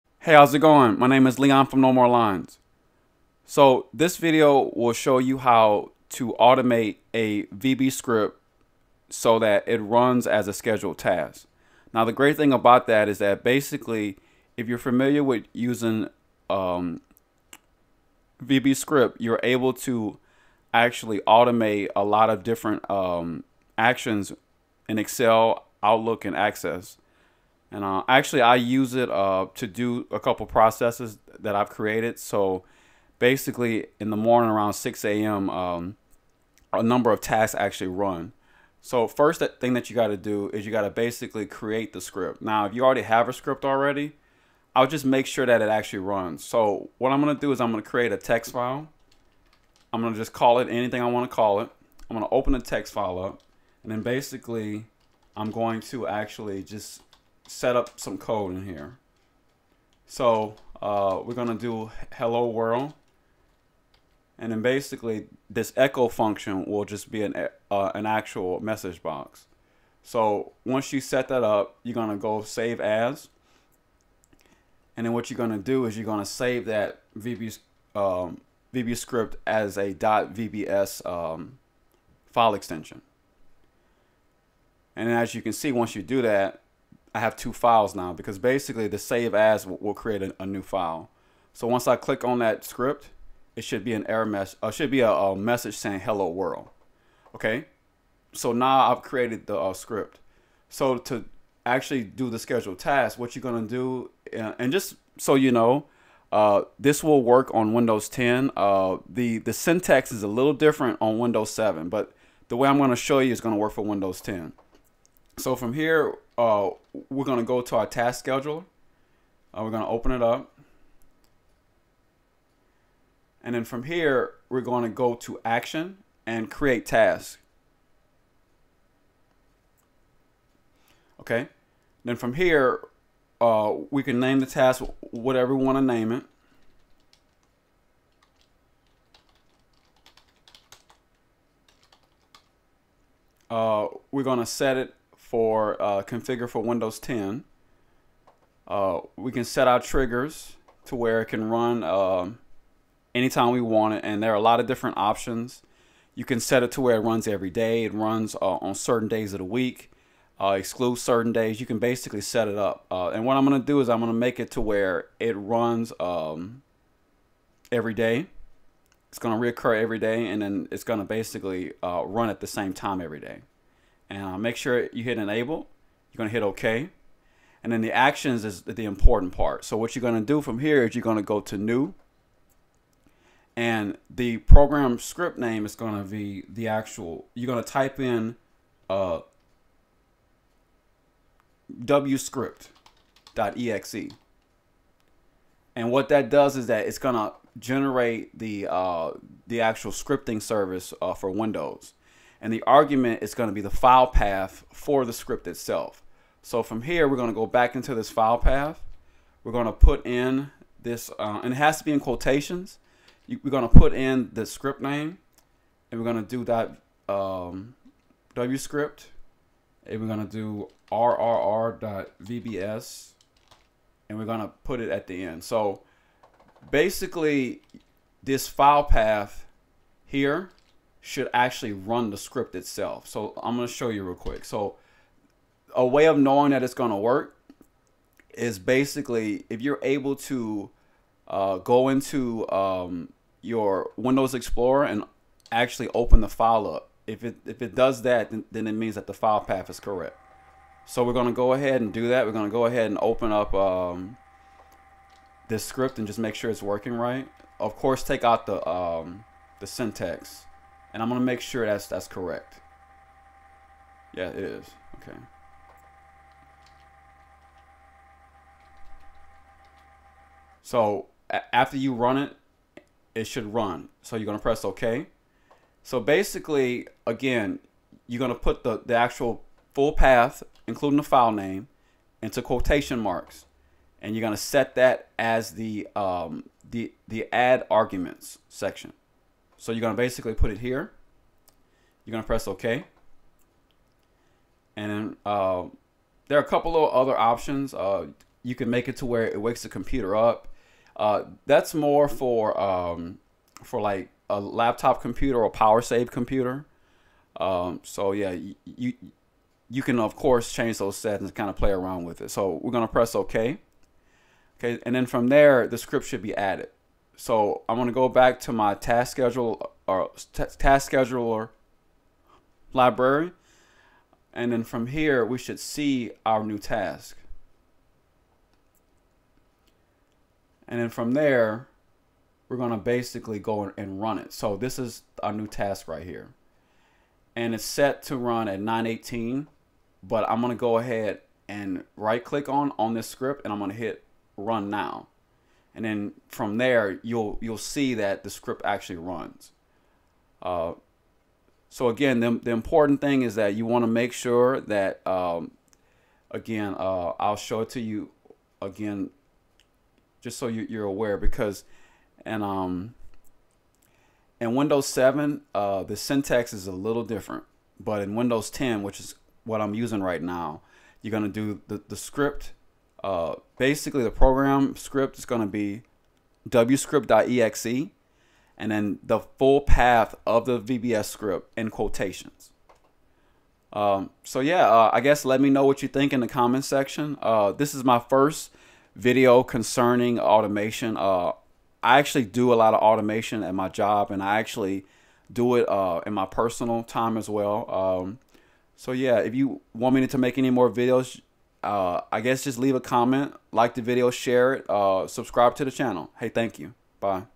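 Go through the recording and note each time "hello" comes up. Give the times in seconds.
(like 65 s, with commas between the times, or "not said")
62 s, 96 s.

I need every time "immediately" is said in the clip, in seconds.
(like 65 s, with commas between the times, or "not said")
not said.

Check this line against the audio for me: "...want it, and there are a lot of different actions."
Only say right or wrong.
wrong.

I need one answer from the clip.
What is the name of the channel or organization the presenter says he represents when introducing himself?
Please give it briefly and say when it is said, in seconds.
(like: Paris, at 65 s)
No More Lines, at 1 s.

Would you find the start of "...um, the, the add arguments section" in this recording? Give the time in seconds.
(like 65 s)
285 s.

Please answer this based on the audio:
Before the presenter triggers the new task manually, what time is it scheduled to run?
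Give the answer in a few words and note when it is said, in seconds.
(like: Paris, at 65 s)
9:18, at 338 s.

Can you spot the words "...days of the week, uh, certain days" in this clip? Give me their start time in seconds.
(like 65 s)
159 s.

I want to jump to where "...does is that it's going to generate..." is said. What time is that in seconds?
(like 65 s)
196 s.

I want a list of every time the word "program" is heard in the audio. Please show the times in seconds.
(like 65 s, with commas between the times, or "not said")
184 s, 374 s.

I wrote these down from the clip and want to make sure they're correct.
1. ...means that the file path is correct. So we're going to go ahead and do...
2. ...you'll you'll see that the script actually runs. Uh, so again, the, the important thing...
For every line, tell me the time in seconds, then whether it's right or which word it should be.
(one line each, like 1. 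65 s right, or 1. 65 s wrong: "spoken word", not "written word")
1. 248 s right
2. 347 s right.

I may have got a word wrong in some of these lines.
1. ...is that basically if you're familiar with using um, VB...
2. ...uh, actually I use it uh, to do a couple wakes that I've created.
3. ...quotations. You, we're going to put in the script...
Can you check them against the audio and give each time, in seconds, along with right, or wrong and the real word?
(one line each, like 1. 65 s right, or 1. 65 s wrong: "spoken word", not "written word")
1. 13 s right
2. 27 s wrong: "processes", not "wakes"
3. 211 s right.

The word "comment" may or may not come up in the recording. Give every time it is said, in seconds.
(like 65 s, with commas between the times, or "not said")
386 s, 402 s.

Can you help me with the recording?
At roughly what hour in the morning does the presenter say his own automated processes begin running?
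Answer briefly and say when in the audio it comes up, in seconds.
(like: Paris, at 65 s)
6 a.m., at 34 s.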